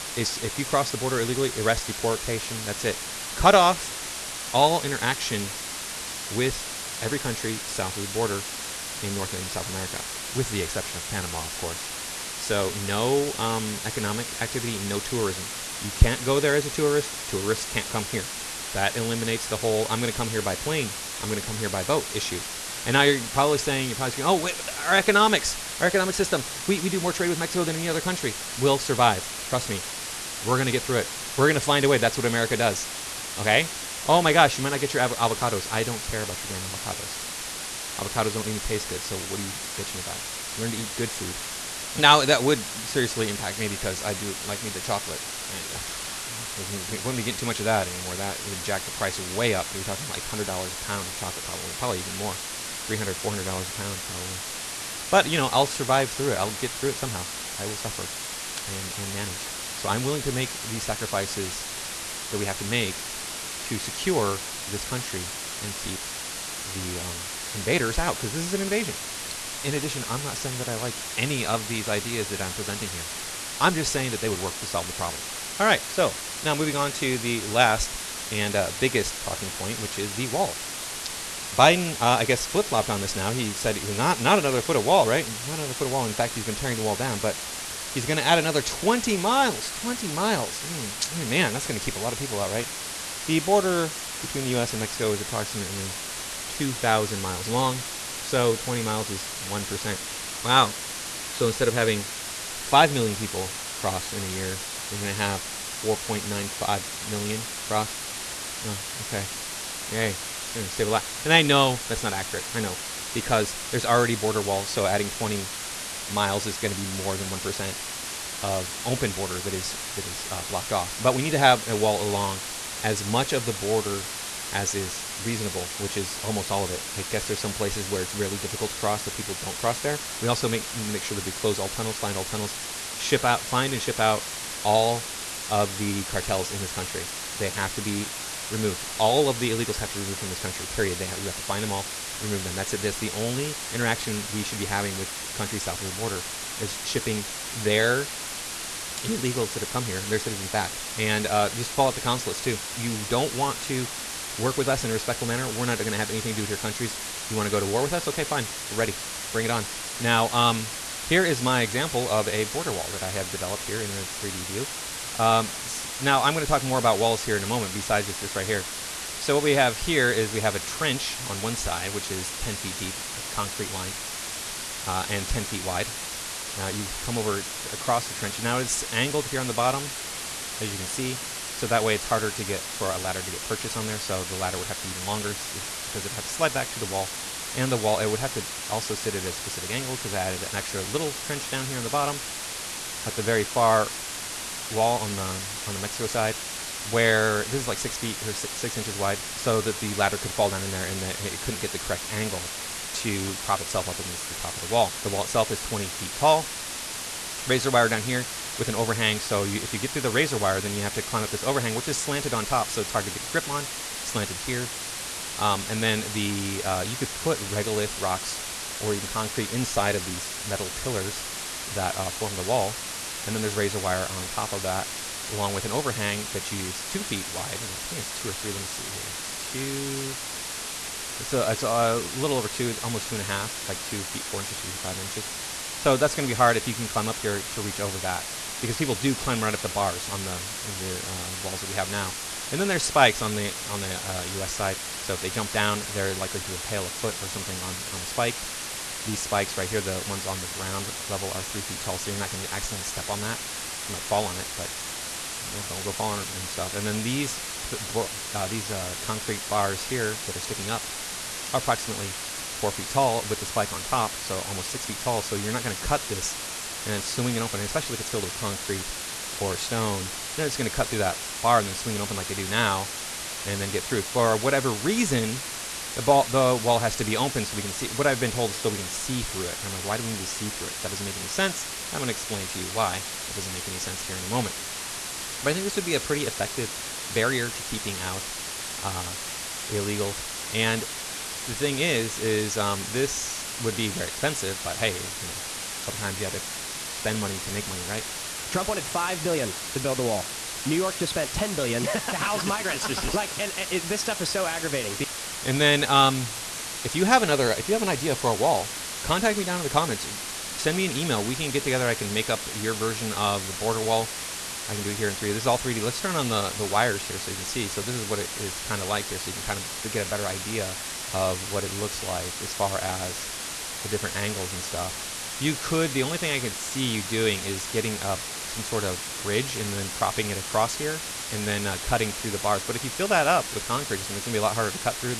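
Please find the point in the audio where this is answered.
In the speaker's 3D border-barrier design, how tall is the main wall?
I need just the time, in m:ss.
3:25.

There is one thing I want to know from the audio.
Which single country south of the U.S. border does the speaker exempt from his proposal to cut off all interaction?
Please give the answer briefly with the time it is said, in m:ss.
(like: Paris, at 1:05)
Panama, at 0:11.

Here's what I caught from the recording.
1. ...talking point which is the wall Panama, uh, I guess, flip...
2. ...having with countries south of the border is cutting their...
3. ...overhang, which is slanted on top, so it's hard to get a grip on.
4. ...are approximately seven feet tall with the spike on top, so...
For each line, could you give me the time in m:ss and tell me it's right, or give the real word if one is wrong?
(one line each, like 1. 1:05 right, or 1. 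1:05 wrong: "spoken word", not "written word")
1. 1:19 wrong: "Biden", not "Panama"
2. 2:24 wrong: "shipping", not "cutting"
3. 3:31 right
4. 4:21 wrong: "four", not "seven".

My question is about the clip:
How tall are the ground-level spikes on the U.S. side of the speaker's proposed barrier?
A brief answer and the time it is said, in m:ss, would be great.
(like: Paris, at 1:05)
3 feet, at 4:11.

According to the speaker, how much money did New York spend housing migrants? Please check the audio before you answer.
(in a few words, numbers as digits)
10 billion.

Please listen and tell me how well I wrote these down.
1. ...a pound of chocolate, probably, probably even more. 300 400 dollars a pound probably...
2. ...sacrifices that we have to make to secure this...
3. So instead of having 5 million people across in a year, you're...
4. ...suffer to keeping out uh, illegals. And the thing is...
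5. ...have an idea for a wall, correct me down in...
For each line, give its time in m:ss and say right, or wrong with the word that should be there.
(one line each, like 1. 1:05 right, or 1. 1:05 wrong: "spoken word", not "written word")
1. 0:50 right
2. 1:00 right
3. 1:41 wrong: "cross", not "across"
4. 4:47 wrong: "barrier", not "suffer"
5. 5:07 wrong: "contact", not "correct".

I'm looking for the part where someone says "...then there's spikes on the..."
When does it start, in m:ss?
4:02.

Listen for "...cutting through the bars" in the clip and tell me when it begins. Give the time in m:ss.
5:31.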